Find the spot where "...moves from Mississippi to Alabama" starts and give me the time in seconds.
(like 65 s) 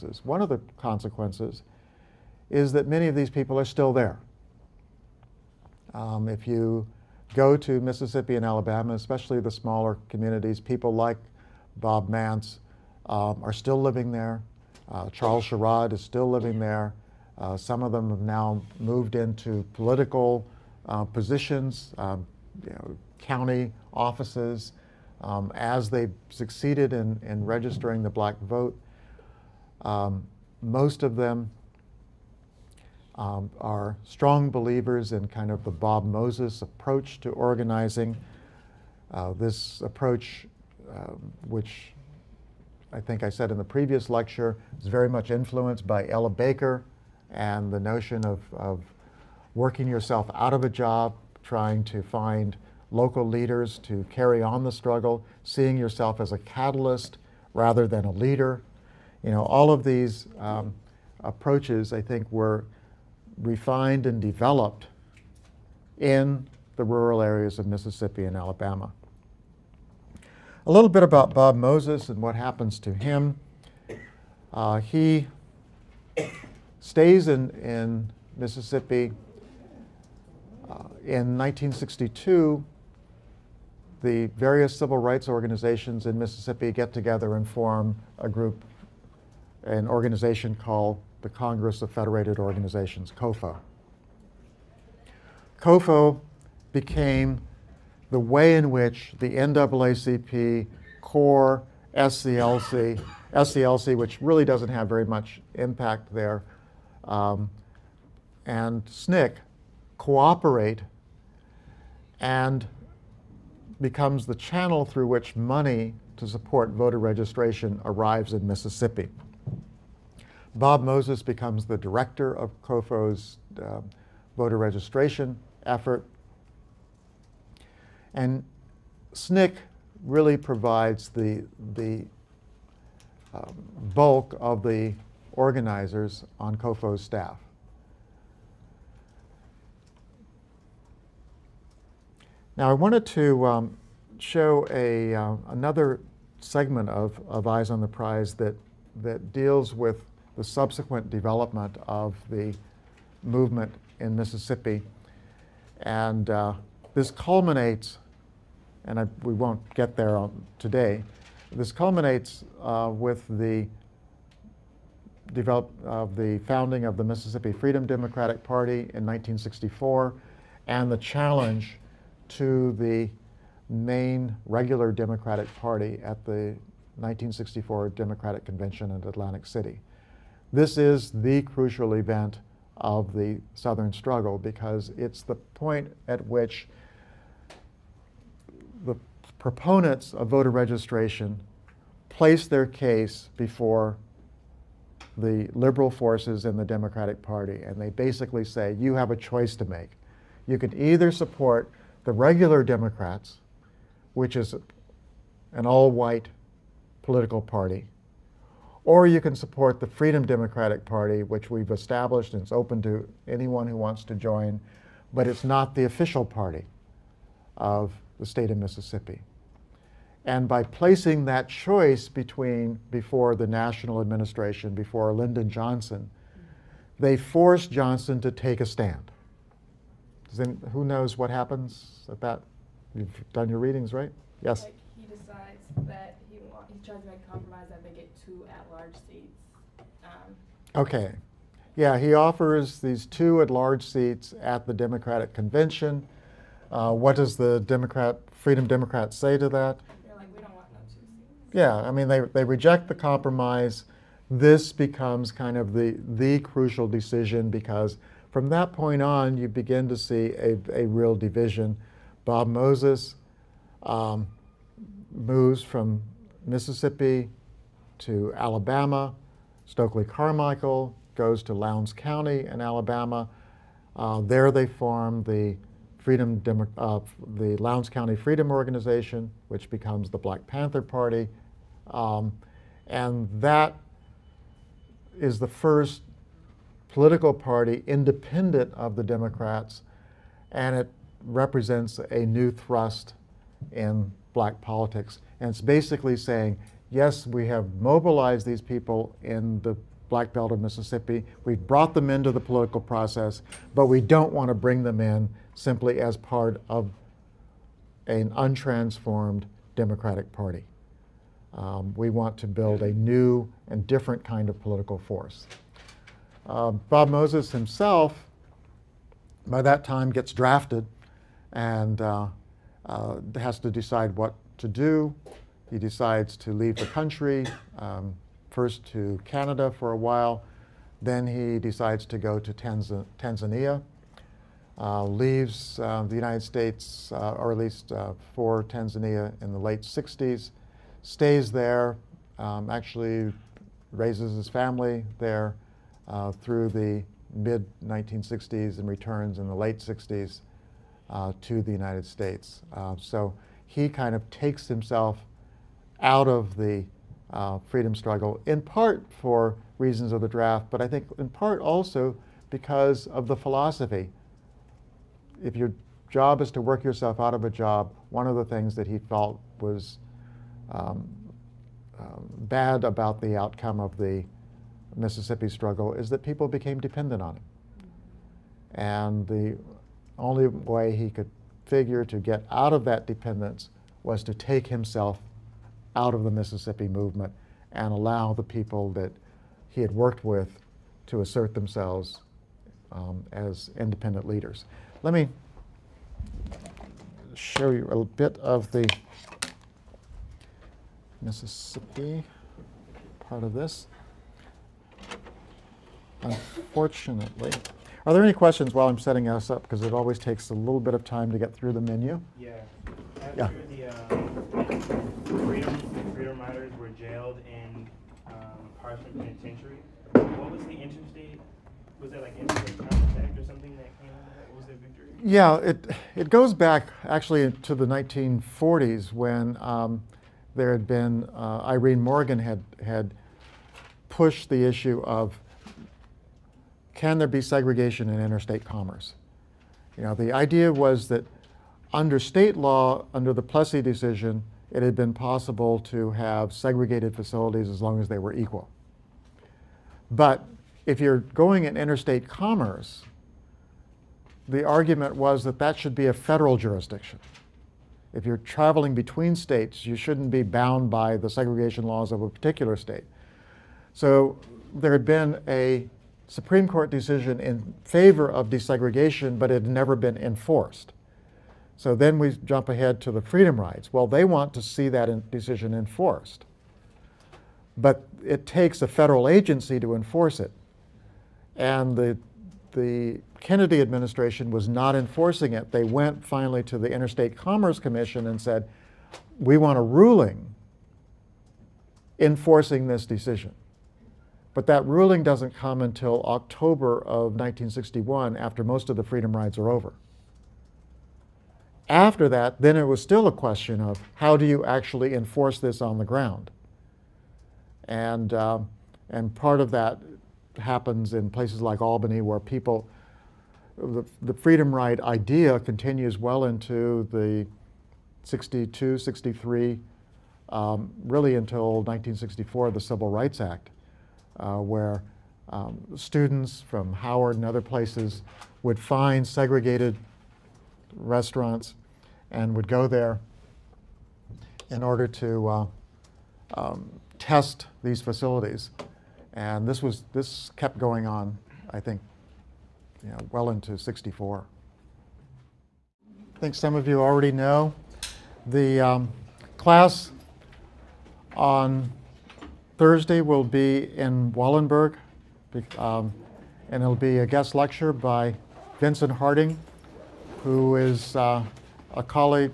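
265 s.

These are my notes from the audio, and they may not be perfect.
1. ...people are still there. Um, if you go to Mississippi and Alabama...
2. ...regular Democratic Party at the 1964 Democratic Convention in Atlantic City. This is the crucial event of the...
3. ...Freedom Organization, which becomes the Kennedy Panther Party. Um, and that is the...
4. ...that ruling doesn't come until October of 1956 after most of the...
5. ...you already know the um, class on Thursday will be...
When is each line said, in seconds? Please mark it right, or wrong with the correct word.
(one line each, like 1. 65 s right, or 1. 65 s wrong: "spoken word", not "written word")
1. 3 s right
2. 174 s right
3. 278 s wrong: "Black", not "Kennedy"
4. 494 s wrong: "1961", not "1956"
5. 546 s right.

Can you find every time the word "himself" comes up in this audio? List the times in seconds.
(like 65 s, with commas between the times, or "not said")
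317 s, 354 s, 384 s.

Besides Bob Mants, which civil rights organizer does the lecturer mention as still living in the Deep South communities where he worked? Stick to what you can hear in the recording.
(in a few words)
Charles Sherrod.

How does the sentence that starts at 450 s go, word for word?
But if you're going in interstate commerce, the argument was that that should be a federal jurisdiction.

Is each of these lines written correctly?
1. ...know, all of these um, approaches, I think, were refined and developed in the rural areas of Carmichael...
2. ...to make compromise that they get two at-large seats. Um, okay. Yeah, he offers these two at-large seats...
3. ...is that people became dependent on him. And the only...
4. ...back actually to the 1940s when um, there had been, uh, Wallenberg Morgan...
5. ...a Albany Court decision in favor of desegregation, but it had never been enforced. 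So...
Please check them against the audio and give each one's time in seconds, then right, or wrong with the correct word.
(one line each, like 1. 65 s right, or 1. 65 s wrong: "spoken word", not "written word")
1. 59 s wrong: "Mississippi", not "Carmichael"
2. 237 s right
3. 375 s right
4. 426 s wrong: "Irene", not "Wallenberg"
5. 465 s wrong: "Supreme", not "Albany".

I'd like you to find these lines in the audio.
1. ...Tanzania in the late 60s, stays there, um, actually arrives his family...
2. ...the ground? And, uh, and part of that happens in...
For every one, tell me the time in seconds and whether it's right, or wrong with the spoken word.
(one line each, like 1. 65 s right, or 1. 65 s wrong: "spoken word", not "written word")
1. 338 s wrong: "raises", not "arrives"
2. 505 s right.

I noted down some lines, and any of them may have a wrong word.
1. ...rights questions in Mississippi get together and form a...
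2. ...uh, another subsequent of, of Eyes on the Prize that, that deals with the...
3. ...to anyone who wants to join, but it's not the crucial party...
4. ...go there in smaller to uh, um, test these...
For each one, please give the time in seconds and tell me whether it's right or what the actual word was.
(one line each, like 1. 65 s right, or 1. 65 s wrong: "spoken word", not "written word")
1. 84 s wrong: "organizations", not "questions"
2. 145 s wrong: "segment", not "subsequent"
3. 212 s wrong: "official", not "crucial"
4. 532 s wrong: "order", not "smaller".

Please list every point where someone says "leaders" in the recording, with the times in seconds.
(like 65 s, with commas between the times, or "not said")
53 s, 58 s, 394 s.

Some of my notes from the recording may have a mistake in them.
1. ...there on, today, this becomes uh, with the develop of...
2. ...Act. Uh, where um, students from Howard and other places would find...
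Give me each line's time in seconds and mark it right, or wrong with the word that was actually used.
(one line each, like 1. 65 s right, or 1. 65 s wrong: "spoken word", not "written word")
1. 159 s wrong: "culminates", not "becomes"
2. 523 s right.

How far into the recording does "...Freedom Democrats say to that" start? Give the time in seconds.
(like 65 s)
248 s.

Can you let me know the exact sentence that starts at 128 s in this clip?
And SNCC really provides the, the um, bulk of the organizers on COFO's staff.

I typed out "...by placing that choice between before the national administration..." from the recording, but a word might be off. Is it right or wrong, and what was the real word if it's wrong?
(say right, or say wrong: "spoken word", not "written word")
right.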